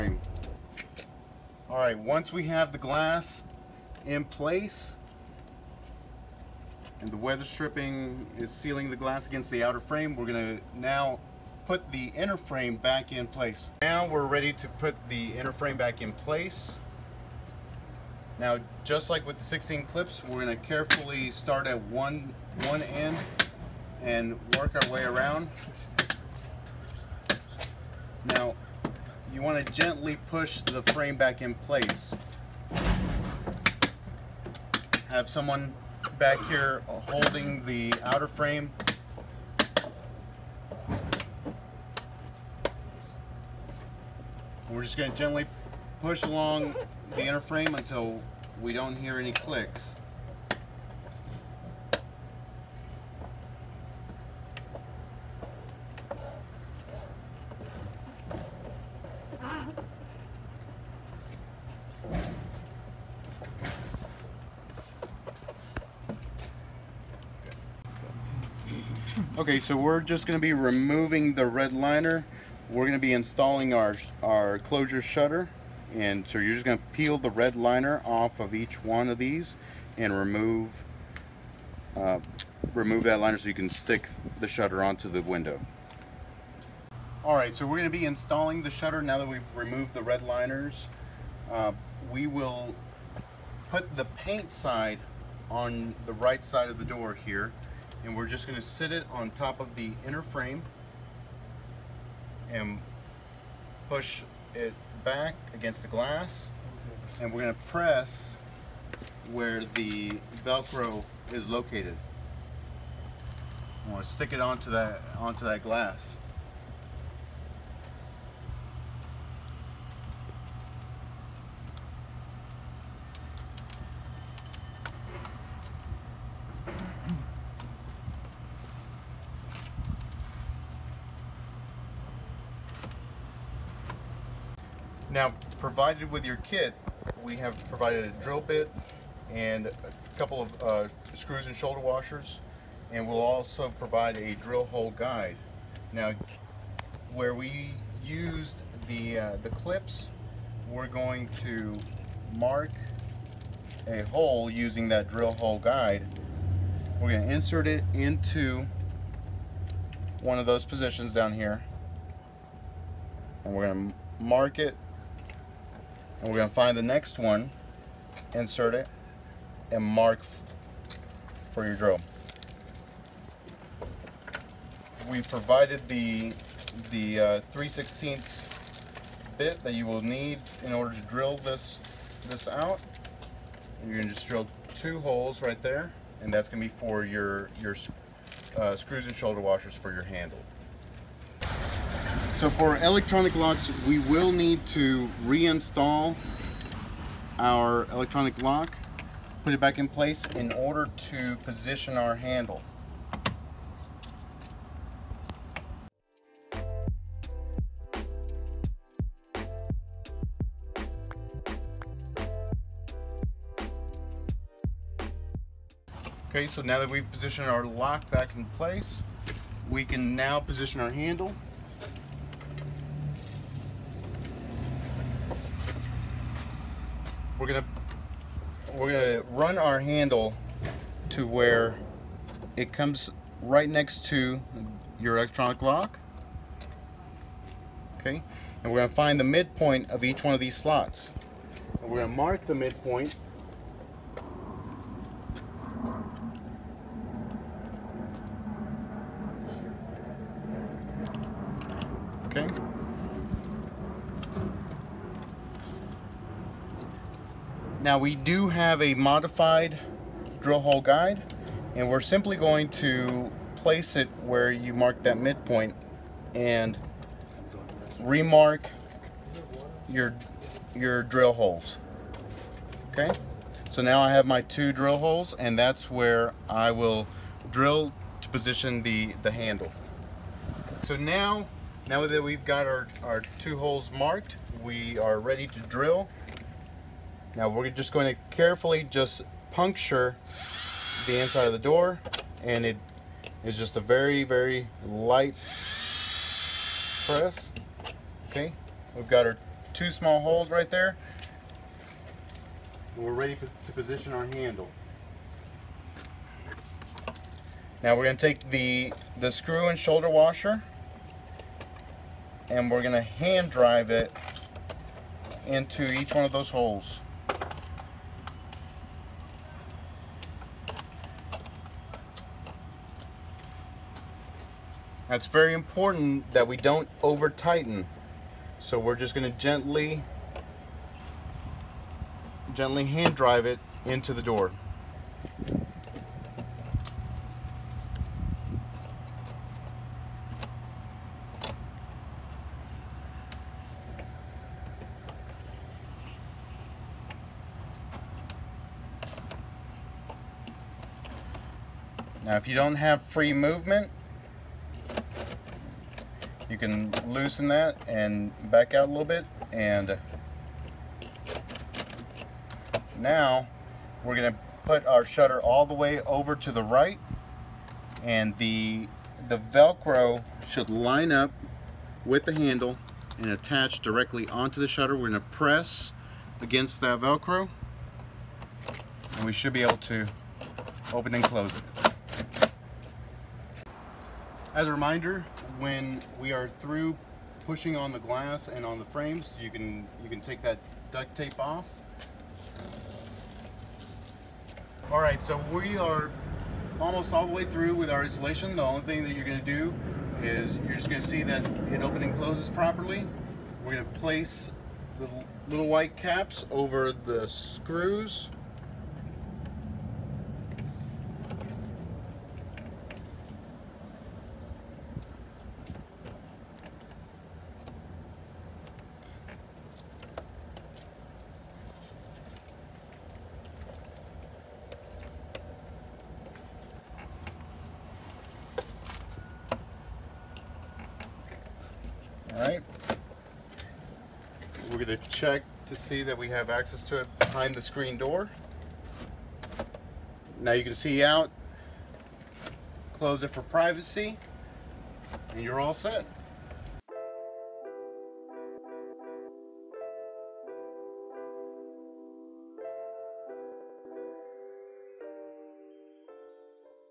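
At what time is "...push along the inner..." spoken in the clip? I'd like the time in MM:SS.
00:46.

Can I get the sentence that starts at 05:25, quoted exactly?
That's very important that we don't over tighten.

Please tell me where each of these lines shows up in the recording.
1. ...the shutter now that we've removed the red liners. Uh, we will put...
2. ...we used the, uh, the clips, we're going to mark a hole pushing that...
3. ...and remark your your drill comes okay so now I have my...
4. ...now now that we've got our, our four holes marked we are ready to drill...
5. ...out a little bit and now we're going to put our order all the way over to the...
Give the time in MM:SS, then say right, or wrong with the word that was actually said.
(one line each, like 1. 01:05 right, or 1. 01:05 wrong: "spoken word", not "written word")
1. 01:28 right
2. 02:27 wrong: "using", not "pushing"
3. 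04:26 wrong: "holes", not "comes"
4. 04:40 wrong: "two", not "four"
5. 05:58 wrong: "shutter", not "order".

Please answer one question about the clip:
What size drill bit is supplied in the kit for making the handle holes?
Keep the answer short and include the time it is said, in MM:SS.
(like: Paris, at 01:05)
3/16, at 02:57.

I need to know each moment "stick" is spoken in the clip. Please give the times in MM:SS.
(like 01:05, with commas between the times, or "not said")
01:23, 01:54.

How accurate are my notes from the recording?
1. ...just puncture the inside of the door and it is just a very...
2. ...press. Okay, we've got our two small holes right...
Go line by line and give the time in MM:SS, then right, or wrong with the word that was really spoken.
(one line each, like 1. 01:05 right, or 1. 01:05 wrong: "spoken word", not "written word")
1. 04:48 right
2. 04:57 right.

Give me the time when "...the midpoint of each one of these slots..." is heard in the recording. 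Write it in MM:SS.
03:59.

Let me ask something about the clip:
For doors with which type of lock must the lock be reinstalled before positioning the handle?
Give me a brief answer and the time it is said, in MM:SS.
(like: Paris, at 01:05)
Electronic locks, at 03:12.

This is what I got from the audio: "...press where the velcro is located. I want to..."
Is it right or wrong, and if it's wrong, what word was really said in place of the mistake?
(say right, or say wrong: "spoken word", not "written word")
right.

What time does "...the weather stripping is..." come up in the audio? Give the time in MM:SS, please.
00:07.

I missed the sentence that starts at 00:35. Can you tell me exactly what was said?
Have someone back here holding the outer frame.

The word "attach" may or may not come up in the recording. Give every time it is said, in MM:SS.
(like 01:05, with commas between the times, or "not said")
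06:13.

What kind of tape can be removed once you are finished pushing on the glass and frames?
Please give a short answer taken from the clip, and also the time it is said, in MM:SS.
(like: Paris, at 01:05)
Duct tape, at 06:30.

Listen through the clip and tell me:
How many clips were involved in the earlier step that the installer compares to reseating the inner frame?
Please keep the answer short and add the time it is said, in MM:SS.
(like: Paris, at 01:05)
16, at 00:19.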